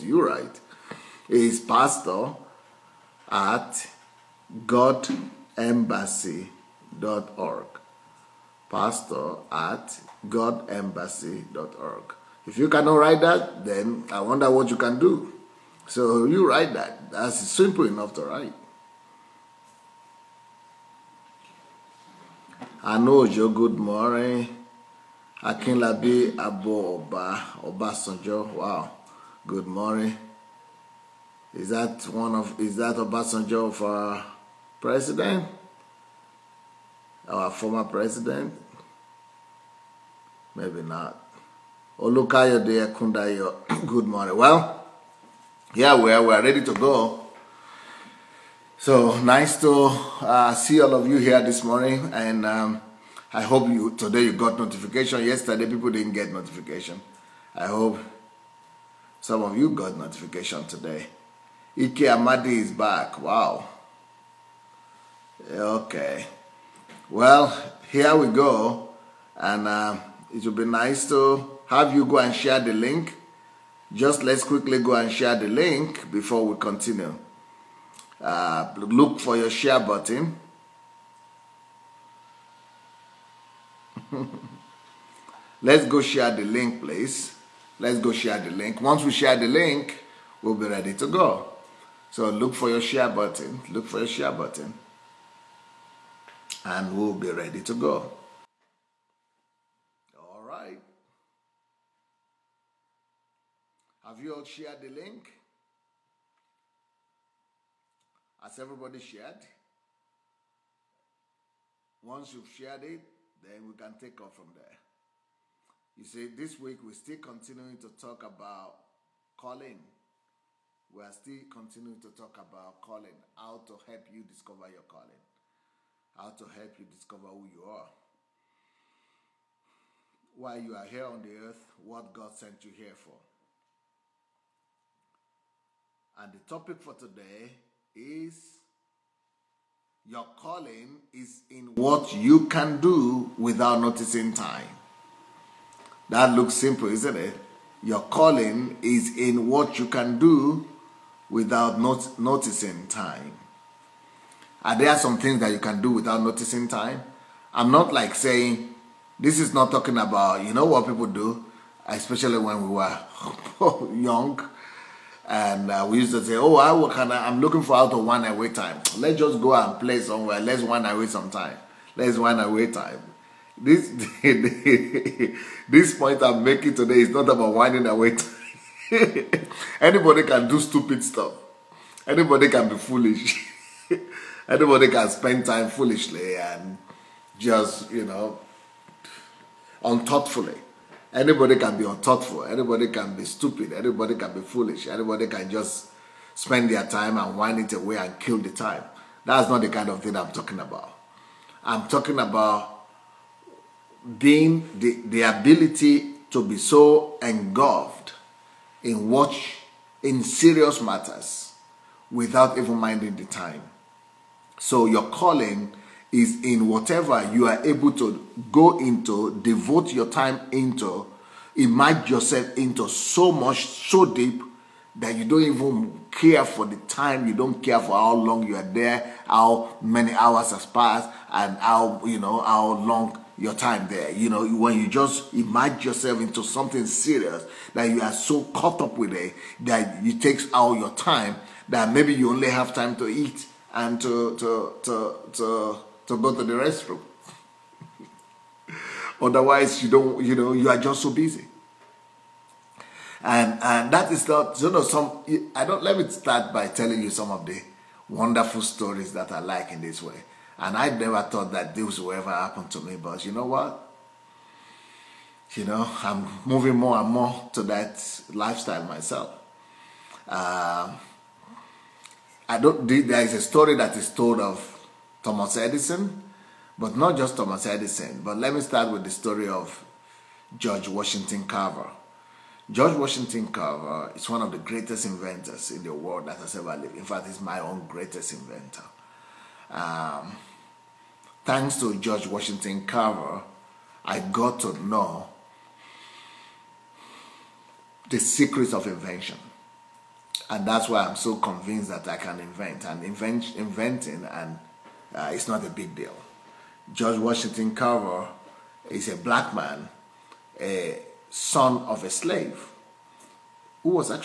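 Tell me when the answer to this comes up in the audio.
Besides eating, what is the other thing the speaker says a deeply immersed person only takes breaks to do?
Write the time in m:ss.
4:06.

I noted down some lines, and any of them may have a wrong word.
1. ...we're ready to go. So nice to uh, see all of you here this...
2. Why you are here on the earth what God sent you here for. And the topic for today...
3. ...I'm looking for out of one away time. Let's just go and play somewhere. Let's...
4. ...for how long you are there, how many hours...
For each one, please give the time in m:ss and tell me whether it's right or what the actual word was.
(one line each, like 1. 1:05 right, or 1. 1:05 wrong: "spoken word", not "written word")
1. 0:46 right
2. 2:10 right
3. 2:47 right
4. 3:47 right.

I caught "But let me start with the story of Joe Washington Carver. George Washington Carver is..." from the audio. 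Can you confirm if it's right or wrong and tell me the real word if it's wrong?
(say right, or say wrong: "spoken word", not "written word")
wrong: "George", not "Joe".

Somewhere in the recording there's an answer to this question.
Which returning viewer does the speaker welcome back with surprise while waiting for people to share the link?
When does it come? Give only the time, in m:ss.
1:01.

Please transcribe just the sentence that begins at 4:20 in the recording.
And I never thought that this would ever happen to me, but you know what?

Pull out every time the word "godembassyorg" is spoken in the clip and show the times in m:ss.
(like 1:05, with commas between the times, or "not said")
0:04, 0:10.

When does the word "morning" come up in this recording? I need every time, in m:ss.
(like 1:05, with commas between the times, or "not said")
0:23, 0:29, 0:44, 0:51.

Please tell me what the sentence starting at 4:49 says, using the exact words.
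Um, thanks to George Washington Carver, I got to know the secrets of invention.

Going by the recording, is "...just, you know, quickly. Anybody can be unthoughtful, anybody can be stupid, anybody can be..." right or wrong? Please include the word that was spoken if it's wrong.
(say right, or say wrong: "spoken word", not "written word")
wrong: "unthoughtfully", not "quickly".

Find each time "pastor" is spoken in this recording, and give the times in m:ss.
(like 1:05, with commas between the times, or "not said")
0:01, 0:08.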